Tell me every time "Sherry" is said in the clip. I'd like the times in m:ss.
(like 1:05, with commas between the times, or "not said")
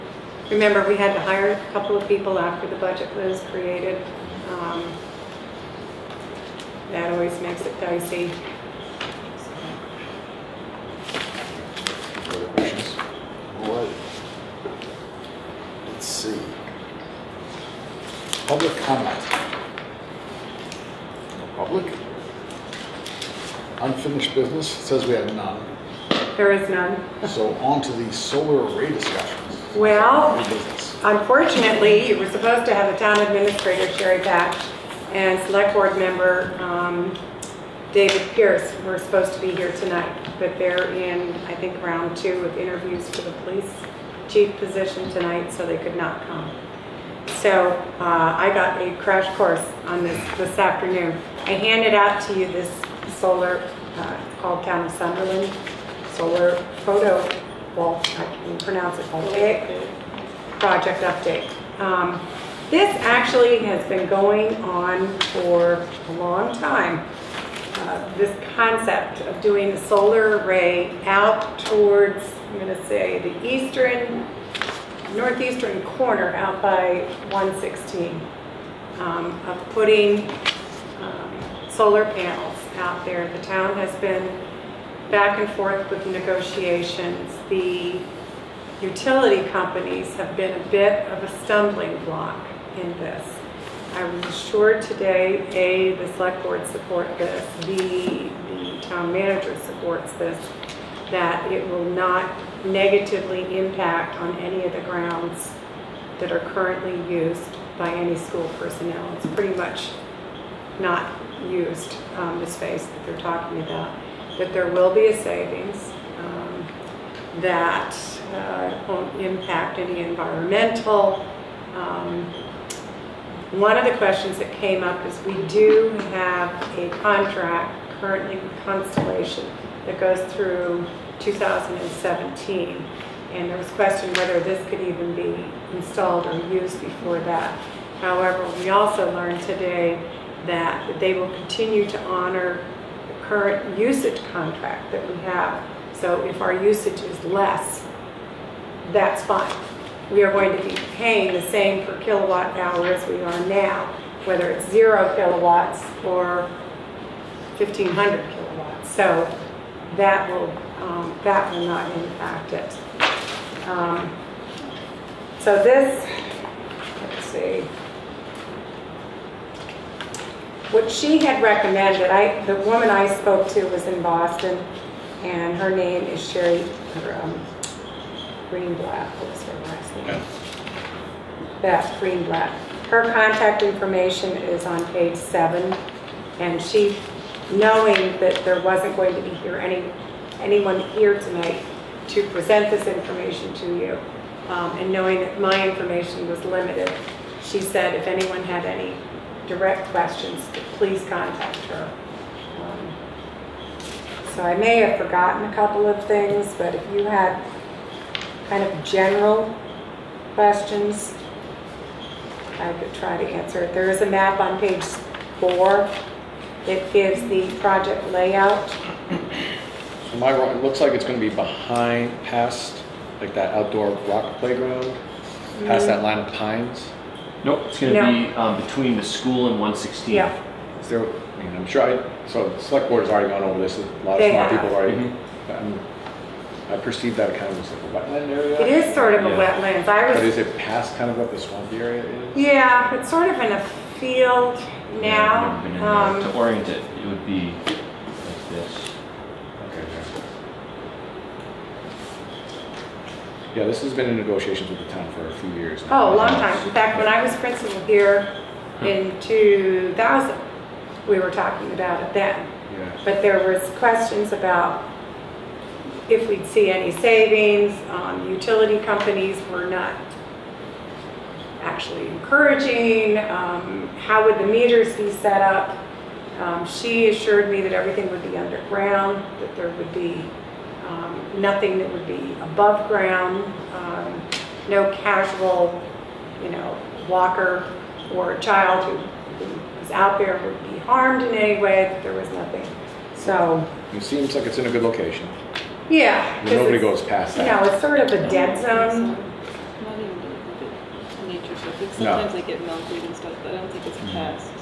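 0:33, 2:56.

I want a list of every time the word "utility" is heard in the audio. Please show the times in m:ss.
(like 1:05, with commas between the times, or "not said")
1:28, 4:28.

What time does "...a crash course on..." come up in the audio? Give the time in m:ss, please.
0:48.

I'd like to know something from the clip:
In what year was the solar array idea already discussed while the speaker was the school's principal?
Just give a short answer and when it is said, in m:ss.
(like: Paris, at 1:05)
2000, at 4:19.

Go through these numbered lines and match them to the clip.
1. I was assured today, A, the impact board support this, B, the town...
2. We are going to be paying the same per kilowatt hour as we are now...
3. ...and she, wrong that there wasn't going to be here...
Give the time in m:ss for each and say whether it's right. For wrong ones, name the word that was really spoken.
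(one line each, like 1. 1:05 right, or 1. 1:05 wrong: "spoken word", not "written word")
1. 1:33 wrong: "select", not "impact"
2. 2:30 right
3. 3:06 wrong: "knowing", not "wrong".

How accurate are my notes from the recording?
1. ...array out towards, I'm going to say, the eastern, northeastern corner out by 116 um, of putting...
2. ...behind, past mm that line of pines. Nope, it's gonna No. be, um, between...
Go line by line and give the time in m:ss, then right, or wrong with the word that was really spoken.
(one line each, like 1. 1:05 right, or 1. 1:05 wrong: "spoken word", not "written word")
1. 1:10 right
2. 3:44 wrong: "playground", not "behind".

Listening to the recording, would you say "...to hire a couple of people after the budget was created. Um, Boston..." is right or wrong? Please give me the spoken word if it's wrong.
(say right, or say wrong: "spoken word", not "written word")
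wrong: "That", not "Boston".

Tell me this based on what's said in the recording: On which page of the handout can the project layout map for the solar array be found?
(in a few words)
page 4.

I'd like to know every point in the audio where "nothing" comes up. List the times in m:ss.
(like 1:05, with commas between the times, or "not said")
4:41, 4:52.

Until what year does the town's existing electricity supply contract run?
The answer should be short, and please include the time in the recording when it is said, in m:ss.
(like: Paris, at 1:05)
2017, at 2:11.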